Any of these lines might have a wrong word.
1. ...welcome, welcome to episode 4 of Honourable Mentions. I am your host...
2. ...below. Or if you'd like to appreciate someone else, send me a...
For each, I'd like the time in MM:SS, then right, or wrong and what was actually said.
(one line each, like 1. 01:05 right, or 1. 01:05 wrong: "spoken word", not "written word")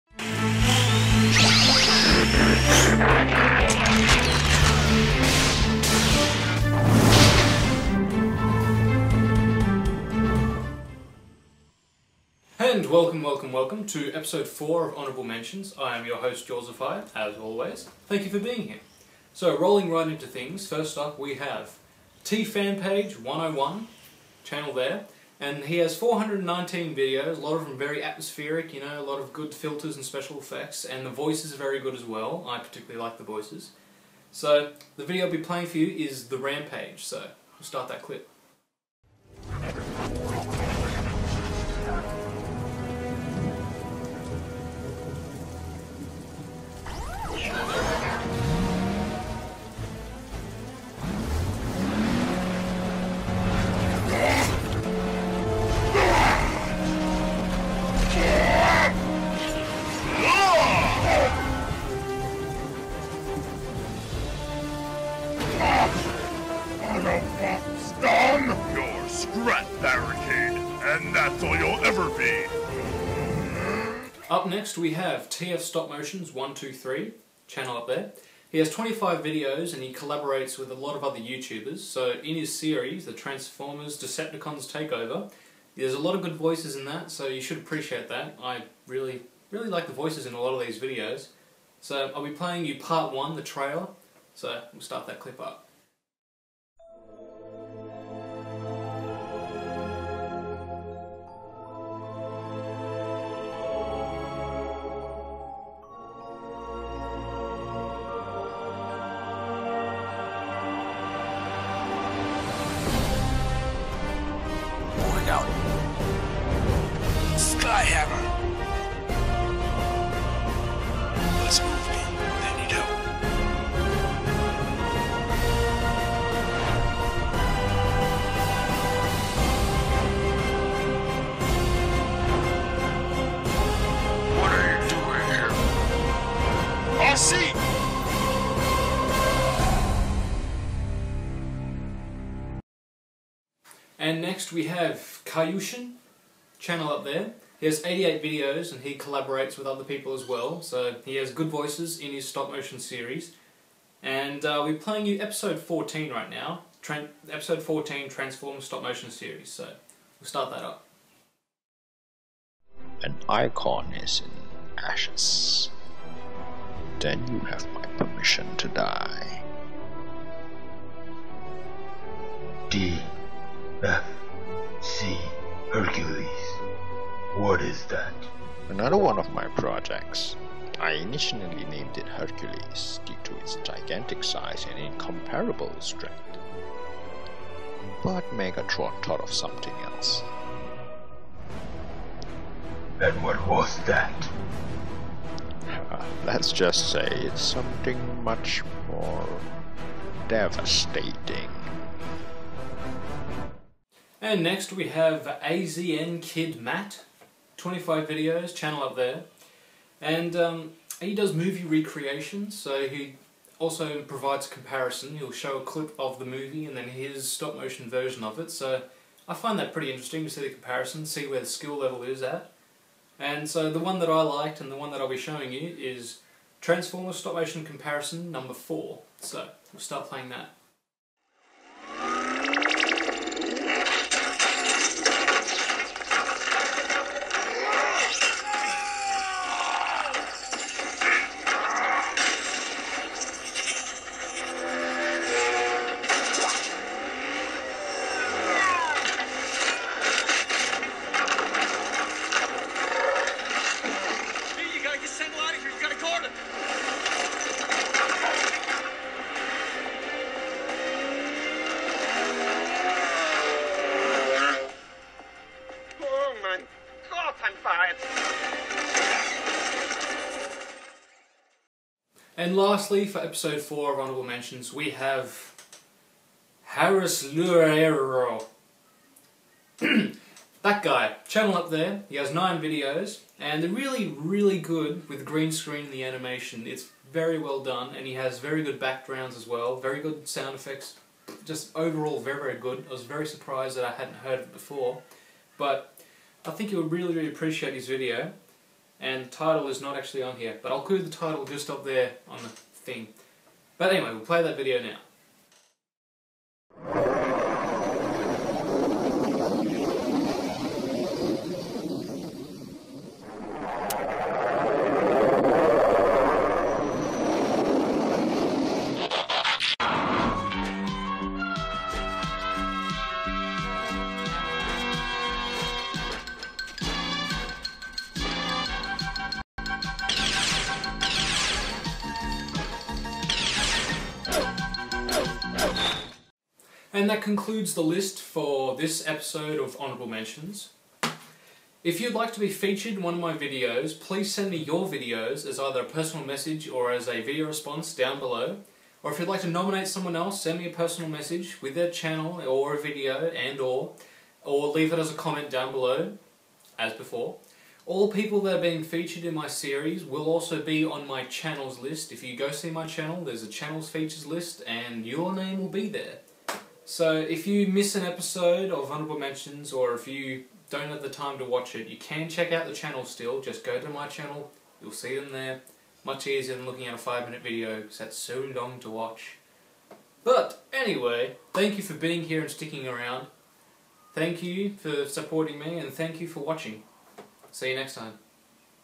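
1. 00:13 right
2. 05:48 wrong: "nominate", not "appreciate".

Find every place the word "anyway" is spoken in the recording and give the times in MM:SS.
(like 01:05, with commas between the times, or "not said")
05:03, 06:20.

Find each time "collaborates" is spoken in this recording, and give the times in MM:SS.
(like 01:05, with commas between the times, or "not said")
01:19, 02:28.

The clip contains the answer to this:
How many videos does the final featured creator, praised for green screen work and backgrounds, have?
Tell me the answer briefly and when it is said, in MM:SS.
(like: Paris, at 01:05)
9, at 04:42.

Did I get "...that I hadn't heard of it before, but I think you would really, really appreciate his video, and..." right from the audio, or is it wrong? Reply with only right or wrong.
right.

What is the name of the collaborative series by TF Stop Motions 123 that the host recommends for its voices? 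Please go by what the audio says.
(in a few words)
Transformers Decepticons Takeover.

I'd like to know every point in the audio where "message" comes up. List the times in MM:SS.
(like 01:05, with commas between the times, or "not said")
05:46, 05:51.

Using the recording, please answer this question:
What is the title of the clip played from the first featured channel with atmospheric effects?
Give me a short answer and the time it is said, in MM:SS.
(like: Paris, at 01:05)
The Rampage, at 00:36.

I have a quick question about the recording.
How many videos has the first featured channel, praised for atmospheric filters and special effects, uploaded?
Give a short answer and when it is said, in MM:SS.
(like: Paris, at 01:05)
419, at 00:25.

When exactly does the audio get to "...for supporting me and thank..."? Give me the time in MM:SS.
06:24.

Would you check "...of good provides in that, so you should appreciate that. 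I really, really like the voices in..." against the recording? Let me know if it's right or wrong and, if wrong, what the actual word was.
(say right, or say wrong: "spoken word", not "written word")
wrong: "voices", not "provides".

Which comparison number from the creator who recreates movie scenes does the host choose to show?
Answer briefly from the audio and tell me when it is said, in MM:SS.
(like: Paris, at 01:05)
4, at 03:48.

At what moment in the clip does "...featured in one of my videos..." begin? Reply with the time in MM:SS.
05:42.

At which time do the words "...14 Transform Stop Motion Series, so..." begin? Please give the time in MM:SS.
02:37.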